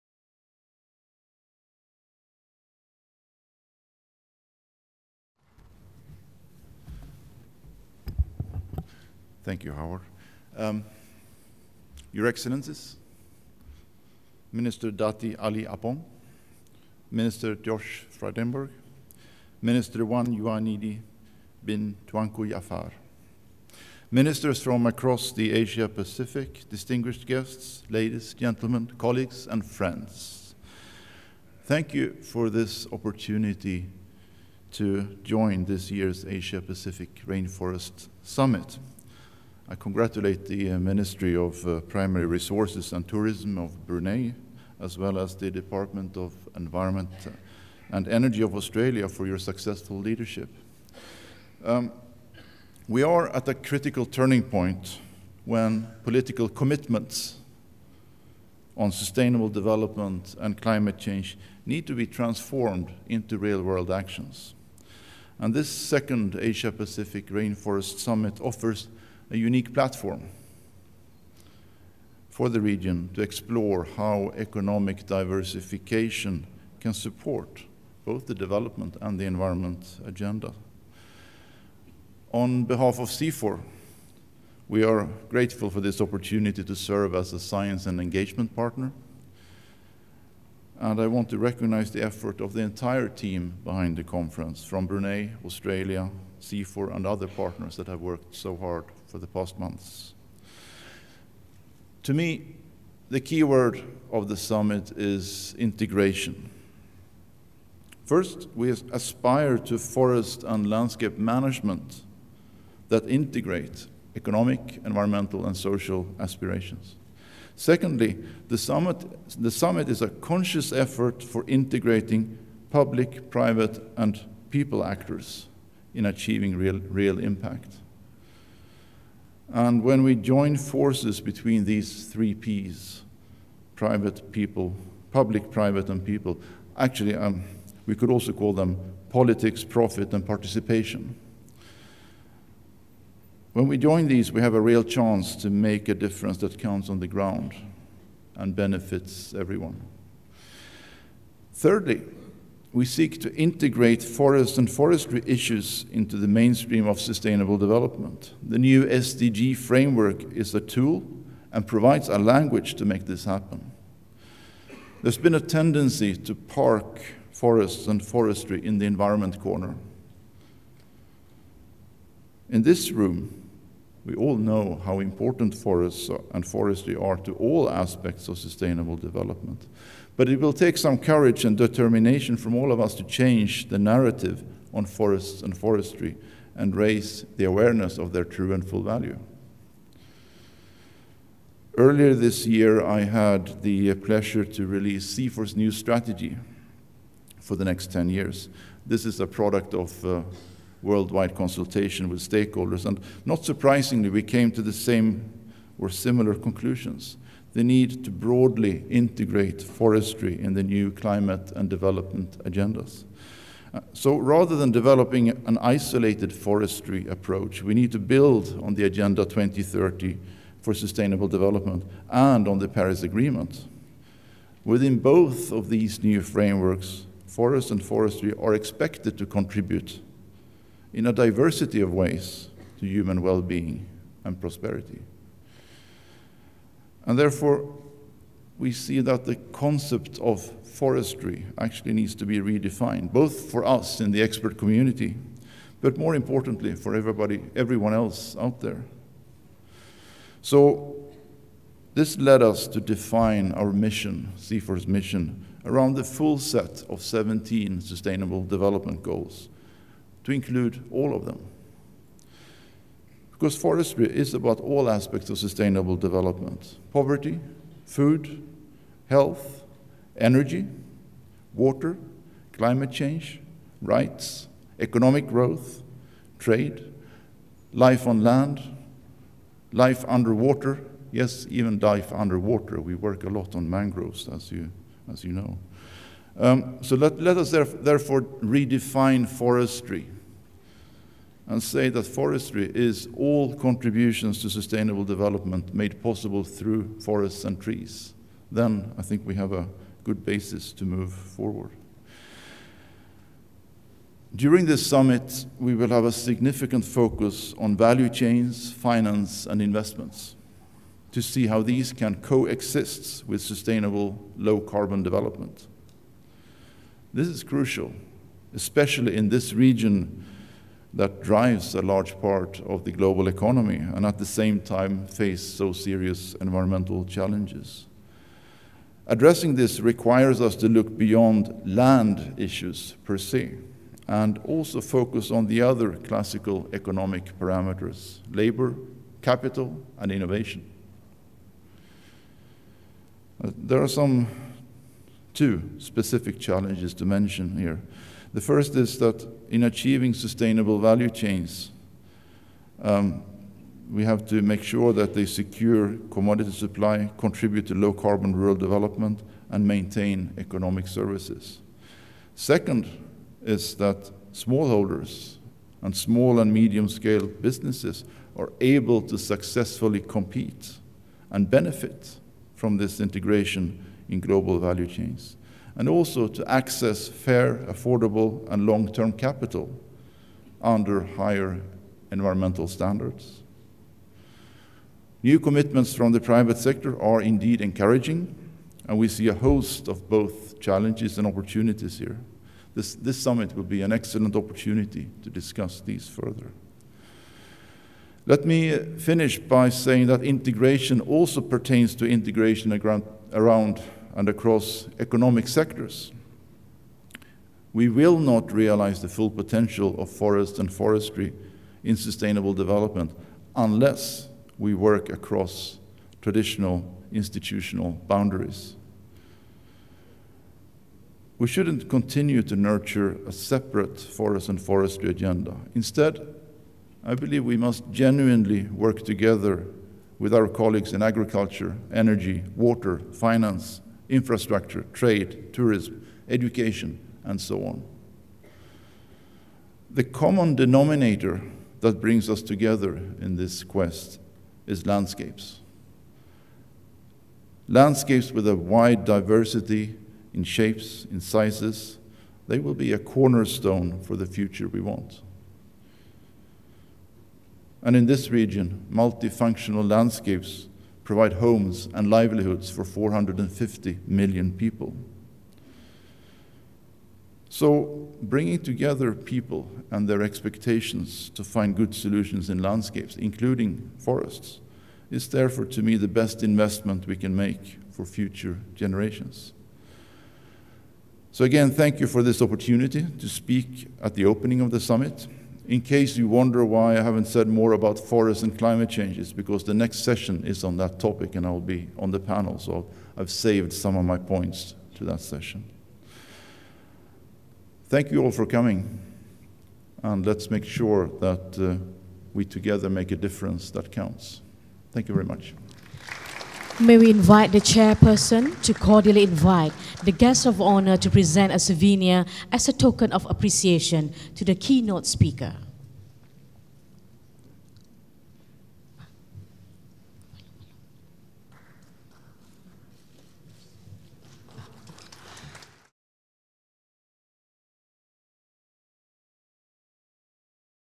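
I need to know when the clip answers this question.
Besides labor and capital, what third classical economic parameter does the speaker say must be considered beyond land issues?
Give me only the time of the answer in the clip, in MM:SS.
05:40.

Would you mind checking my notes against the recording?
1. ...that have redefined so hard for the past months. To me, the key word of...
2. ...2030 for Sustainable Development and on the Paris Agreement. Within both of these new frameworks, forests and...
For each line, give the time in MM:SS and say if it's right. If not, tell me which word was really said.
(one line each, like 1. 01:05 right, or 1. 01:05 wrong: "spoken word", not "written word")
1. 01:37 wrong: "worked", not "redefined"
2. 03:39 right.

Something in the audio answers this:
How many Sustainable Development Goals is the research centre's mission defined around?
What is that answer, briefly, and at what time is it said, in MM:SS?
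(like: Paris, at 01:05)
17, at 04:17.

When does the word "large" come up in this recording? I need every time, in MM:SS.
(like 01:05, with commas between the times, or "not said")
05:21.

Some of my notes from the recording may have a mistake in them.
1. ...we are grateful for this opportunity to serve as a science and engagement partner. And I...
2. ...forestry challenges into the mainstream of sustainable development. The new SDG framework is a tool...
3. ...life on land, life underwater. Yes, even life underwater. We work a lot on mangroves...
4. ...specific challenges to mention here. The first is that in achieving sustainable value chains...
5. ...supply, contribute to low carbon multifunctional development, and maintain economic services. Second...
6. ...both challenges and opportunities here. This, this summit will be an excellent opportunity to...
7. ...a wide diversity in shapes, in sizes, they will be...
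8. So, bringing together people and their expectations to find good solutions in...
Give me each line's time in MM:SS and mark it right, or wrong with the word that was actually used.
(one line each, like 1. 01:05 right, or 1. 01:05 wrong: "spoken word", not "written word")
1. 01:24 right
2. 02:34 wrong: "issues", not "challenges"
3. 04:37 right
4. 05:45 right
5. 05:56 wrong: "rural", not "multifunctional"
6. 06:30 right
7. 07:28 right
8. 07:47 right.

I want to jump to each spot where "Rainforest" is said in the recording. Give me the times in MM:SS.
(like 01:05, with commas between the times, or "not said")
00:37, 01:07.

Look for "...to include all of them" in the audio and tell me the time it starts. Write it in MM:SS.
04:20.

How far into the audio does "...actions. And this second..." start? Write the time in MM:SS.
01:03.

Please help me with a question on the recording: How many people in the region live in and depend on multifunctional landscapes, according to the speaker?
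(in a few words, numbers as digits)
450 million.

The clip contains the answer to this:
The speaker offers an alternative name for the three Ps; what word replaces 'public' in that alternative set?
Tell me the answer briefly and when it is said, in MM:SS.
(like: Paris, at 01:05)
Politics, at 02:19.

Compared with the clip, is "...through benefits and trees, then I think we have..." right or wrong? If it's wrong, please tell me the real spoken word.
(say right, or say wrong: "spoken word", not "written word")
wrong: "forests", not "benefits".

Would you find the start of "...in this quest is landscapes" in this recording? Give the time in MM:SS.
07:23.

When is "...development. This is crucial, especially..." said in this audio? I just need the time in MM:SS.
05:15.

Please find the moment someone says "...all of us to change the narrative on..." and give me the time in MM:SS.
03:02.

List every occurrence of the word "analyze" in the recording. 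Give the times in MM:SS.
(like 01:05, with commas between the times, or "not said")
not said.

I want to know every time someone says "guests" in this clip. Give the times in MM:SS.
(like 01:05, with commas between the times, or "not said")
00:27, 08:30.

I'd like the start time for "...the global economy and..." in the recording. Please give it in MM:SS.
05:22.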